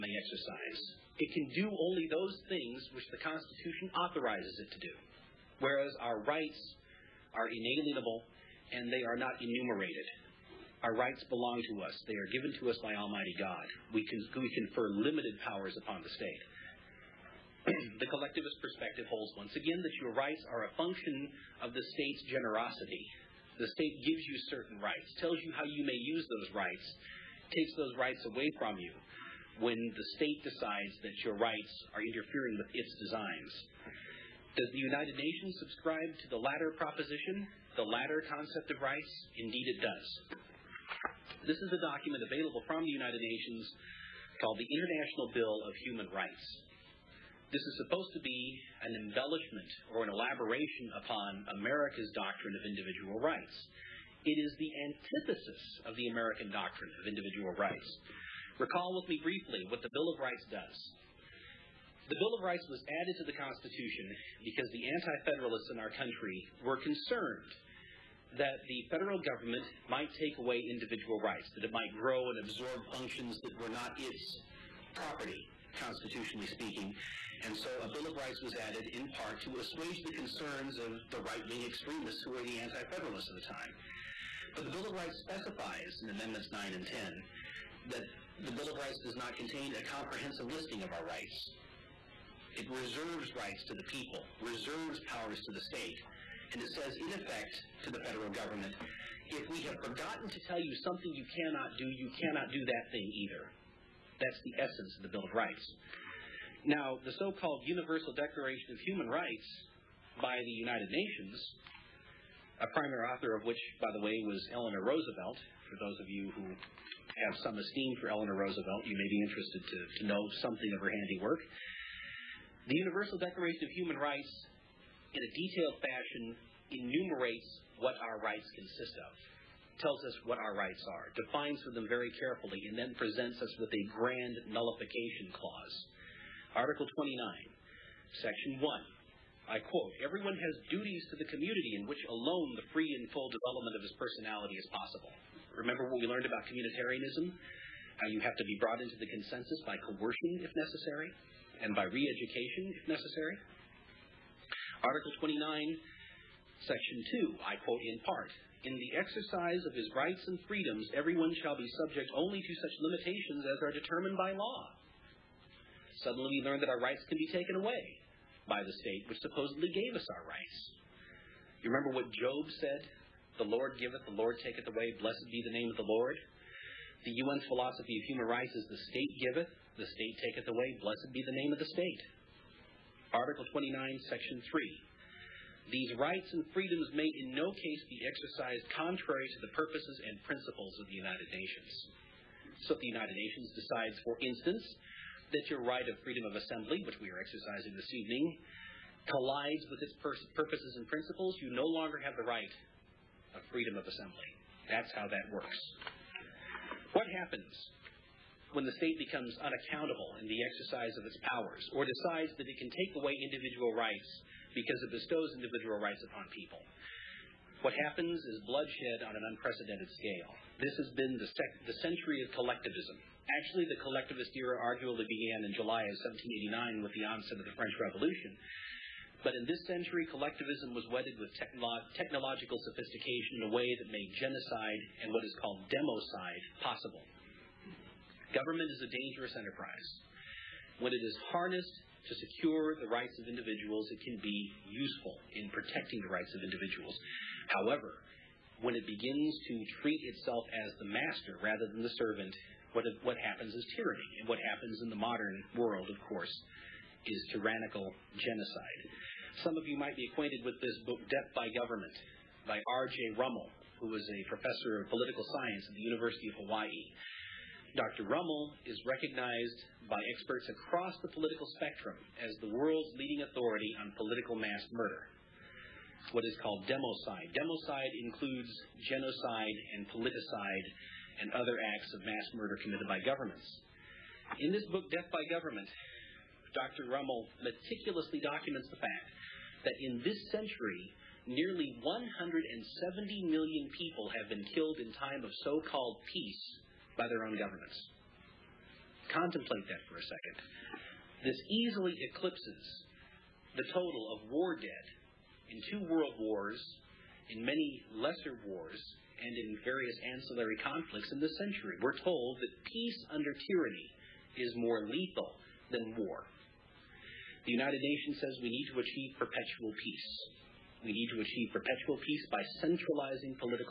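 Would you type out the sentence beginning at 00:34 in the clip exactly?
Does the United Nations subscribe to the latter proposition, the latter concept of rights?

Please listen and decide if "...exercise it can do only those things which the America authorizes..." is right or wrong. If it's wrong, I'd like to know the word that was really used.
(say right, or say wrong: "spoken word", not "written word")
wrong: "Constitution", not "America".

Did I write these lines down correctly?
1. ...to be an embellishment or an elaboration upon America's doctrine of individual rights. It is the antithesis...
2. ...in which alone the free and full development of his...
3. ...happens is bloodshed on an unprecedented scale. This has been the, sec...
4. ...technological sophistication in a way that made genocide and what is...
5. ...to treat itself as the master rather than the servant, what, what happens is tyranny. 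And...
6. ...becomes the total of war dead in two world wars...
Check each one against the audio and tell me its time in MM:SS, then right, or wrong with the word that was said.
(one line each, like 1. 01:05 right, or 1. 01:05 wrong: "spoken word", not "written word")
1. 00:48 right
2. 02:21 right
3. 03:37 right
4. 03:51 right
5. 04:09 right
6. 05:02 wrong: "eclipses", not "becomes".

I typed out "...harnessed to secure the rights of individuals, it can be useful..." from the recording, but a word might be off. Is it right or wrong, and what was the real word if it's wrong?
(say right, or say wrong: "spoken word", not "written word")
right.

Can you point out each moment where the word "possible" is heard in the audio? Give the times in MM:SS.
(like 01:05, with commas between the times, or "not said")
02:24, 03:56.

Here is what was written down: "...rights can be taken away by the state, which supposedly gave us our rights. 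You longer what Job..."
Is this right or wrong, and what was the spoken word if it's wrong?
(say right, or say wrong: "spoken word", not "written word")
wrong: "remember", not "longer".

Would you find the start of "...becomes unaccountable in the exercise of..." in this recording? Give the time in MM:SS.
03:28.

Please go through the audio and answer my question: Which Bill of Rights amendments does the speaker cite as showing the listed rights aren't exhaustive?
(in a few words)
9 and 10.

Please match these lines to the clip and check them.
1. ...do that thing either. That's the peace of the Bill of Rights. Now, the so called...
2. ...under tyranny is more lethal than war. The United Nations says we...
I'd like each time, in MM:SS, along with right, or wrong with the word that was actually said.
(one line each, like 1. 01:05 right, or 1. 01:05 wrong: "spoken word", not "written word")
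1. 01:42 wrong: "essence", not "peace"
2. 05:13 right.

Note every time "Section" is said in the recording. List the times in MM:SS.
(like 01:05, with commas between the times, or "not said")
02:18, 02:36, 03:04.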